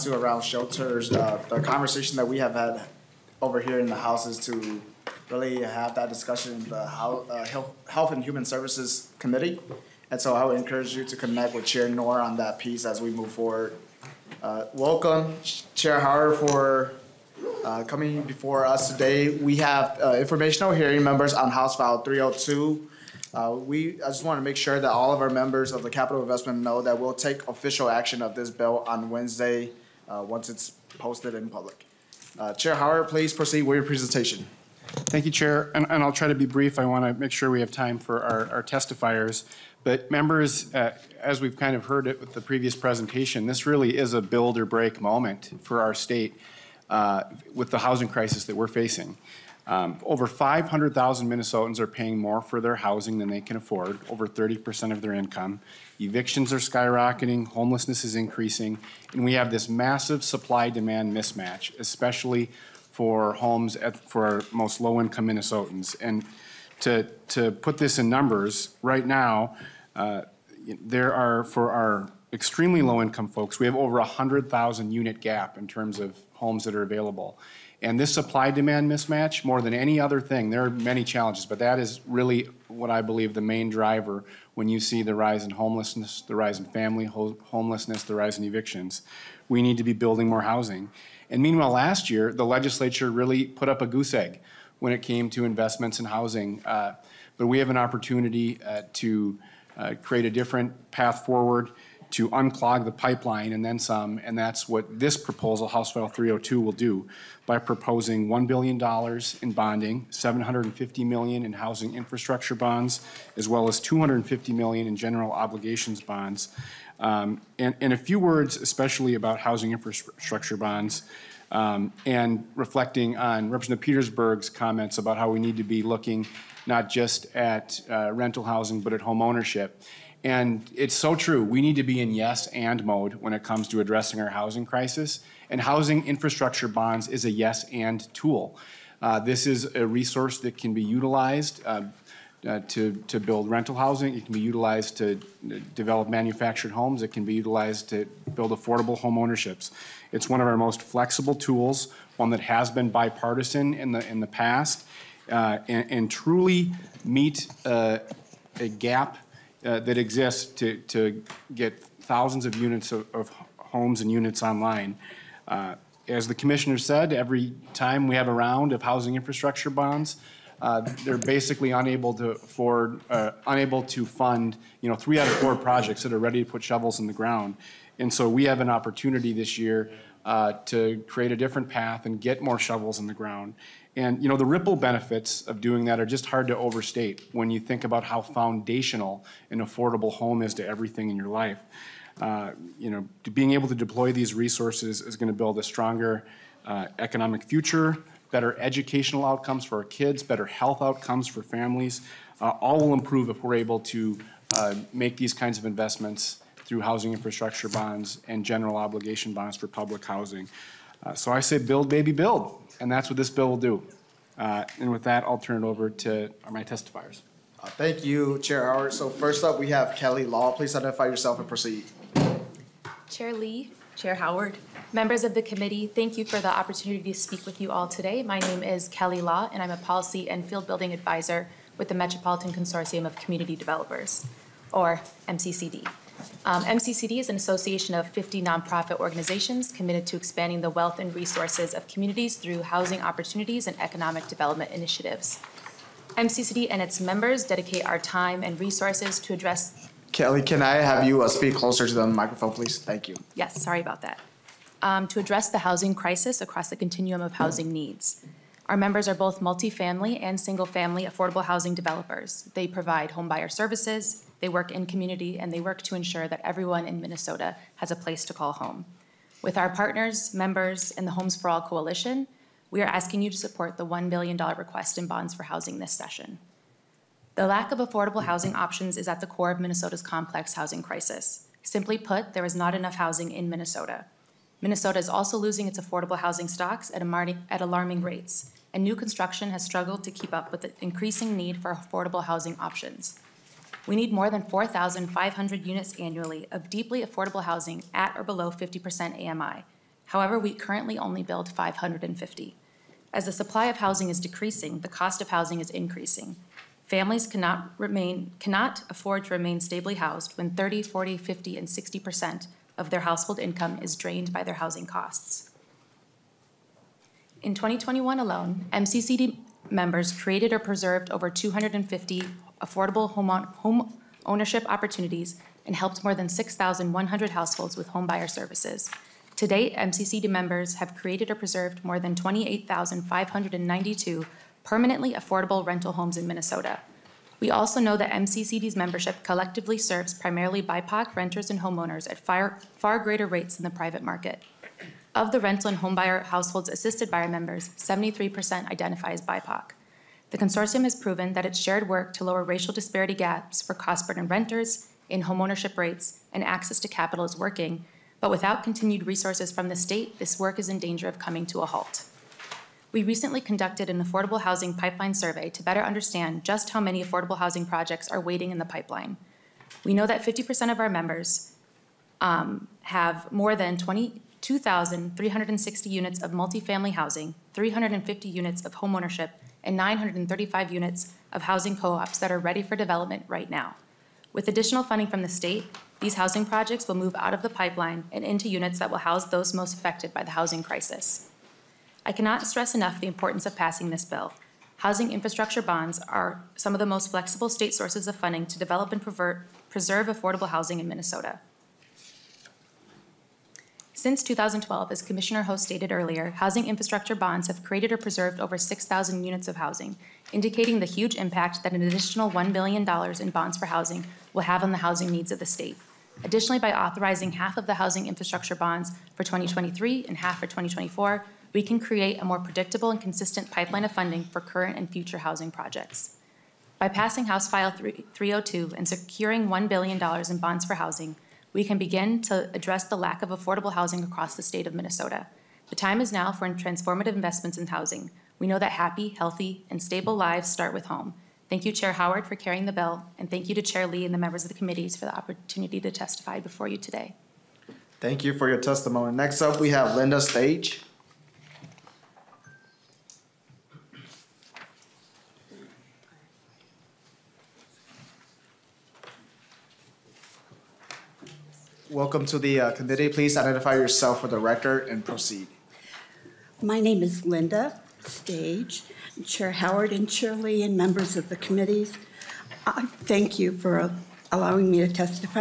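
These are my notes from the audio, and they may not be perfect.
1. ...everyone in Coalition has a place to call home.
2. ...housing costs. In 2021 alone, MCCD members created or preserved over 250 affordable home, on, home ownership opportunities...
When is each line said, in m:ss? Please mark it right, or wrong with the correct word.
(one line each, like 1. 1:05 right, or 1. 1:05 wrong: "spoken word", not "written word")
1. 4:26 wrong: "Minnesota", not "Coalition"
2. 5:14 right.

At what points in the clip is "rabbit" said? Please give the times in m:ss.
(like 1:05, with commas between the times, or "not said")
not said.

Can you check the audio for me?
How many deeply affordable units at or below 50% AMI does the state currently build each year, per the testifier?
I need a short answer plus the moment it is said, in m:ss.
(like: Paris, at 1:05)
550, at 5:01.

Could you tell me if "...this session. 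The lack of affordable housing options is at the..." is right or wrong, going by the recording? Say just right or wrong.
right.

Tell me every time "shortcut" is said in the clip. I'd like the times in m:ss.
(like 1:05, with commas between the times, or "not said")
not said.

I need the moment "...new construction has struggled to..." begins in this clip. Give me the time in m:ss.
4:48.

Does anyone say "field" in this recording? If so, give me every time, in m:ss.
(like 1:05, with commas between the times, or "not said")
3:50.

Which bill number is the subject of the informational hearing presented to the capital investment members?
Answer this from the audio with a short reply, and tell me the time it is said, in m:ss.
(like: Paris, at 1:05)
House File 302, at 0:21.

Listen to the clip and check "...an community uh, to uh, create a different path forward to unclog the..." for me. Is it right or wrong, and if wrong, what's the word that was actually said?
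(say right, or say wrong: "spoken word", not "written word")
wrong: "opportunity", not "community".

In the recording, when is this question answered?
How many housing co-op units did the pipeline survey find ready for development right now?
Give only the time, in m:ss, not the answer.
6:19.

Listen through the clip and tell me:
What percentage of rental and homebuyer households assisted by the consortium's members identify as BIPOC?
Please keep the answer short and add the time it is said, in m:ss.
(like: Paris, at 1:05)
73%, at 5:47.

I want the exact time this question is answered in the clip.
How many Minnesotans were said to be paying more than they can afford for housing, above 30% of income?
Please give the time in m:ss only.
0:50.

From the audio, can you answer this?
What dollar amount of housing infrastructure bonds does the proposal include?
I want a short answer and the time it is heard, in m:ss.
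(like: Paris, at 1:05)
$750 million, at 1:50.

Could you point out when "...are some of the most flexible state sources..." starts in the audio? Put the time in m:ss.
6:36.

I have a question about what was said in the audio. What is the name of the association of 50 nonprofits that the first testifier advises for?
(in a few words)
Metropolitan Consortium of Community Developers.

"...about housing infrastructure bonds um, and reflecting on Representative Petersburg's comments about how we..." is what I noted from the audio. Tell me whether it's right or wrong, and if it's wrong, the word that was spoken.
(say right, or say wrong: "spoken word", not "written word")
right.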